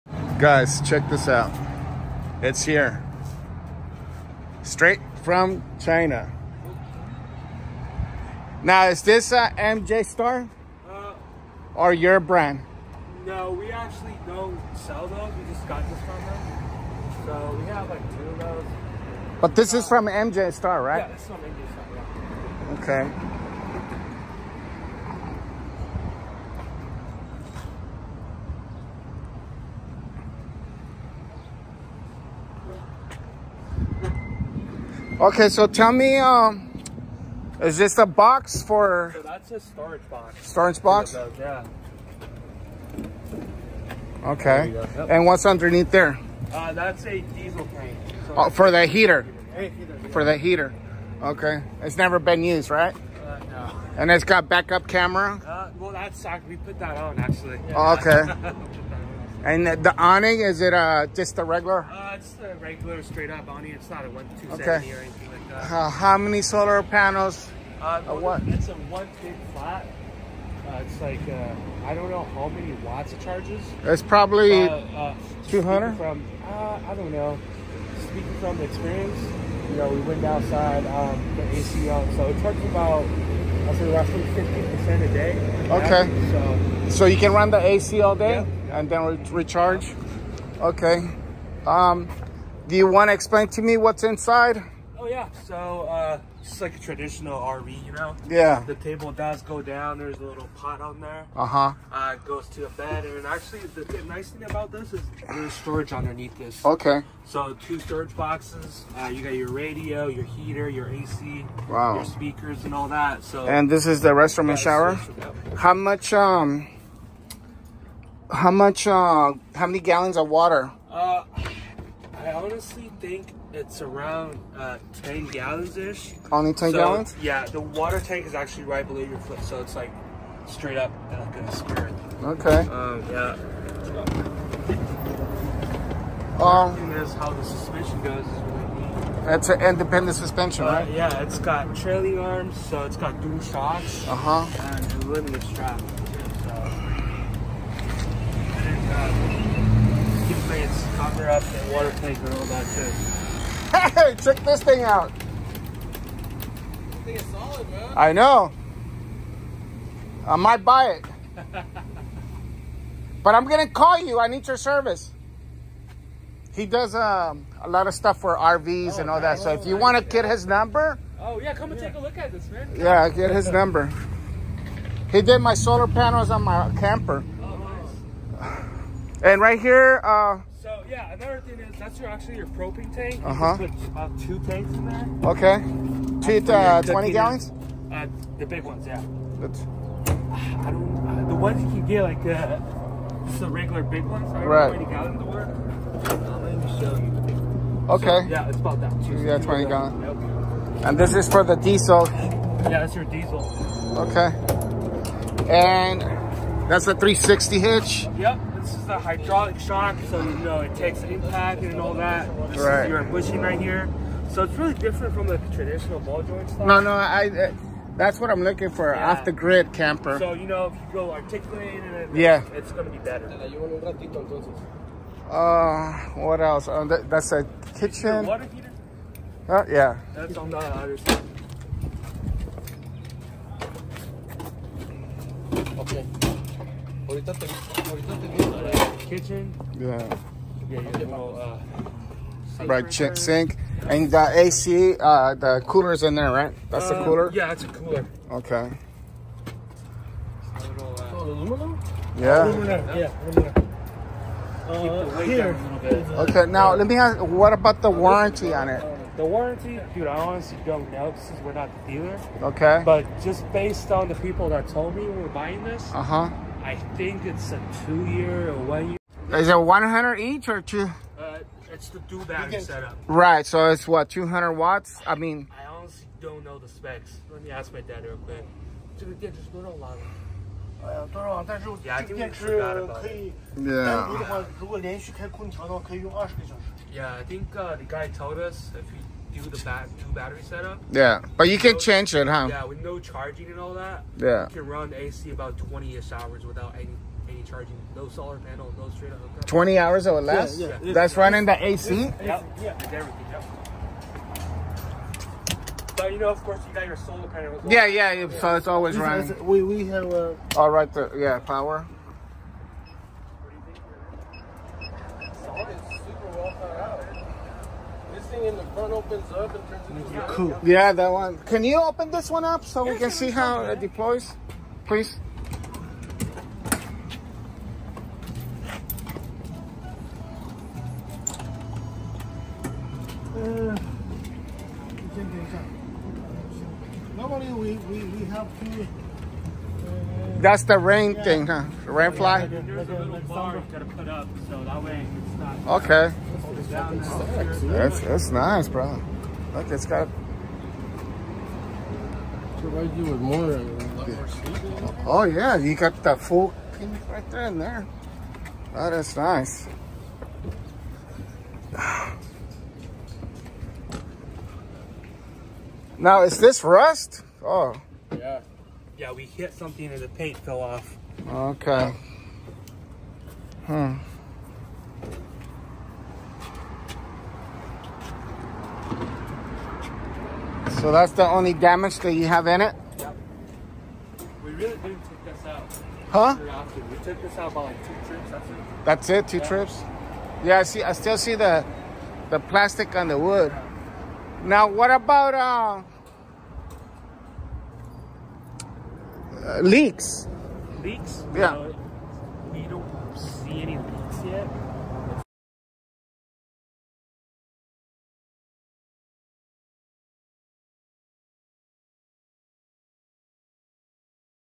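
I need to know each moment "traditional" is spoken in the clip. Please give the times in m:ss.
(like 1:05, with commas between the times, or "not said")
1:36, 3:35.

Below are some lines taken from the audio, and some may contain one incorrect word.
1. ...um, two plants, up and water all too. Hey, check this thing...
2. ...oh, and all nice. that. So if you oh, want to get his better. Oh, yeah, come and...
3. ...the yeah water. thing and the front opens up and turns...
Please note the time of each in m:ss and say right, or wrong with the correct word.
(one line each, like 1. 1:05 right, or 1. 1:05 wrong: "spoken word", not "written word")
1. 2:28 right
2. 2:48 wrong: "number", not "better"
3. 5:10 wrong: "power", not "water".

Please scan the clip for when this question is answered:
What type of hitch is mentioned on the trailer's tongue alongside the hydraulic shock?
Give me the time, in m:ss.
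3:26.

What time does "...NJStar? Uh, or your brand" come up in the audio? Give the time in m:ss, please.
0:09.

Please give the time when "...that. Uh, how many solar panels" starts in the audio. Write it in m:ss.
1:05.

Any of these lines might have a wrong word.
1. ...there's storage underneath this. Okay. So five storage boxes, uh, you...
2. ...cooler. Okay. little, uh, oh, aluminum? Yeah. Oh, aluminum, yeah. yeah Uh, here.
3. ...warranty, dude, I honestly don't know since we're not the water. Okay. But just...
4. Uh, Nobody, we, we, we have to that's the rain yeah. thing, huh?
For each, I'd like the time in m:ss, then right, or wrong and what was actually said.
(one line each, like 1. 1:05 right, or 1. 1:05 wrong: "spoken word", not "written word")
1. 1:45 wrong: "two", not "five"
2. 4:07 right
3. 4:19 wrong: "dealer", not "water"
4. 5:33 right.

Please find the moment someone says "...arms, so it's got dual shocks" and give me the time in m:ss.
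2:22.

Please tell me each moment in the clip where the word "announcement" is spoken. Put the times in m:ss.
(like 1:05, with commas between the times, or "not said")
not said.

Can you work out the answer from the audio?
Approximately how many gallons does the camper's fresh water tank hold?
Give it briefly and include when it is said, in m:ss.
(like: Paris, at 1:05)
10 gallons, at 2:05.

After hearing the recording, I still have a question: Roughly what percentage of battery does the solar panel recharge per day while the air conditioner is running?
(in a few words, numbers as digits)
15%.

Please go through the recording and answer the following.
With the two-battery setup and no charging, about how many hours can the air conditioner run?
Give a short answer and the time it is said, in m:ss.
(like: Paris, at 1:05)
20 hours, at 4:55.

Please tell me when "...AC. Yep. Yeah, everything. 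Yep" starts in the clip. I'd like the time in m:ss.
5:01.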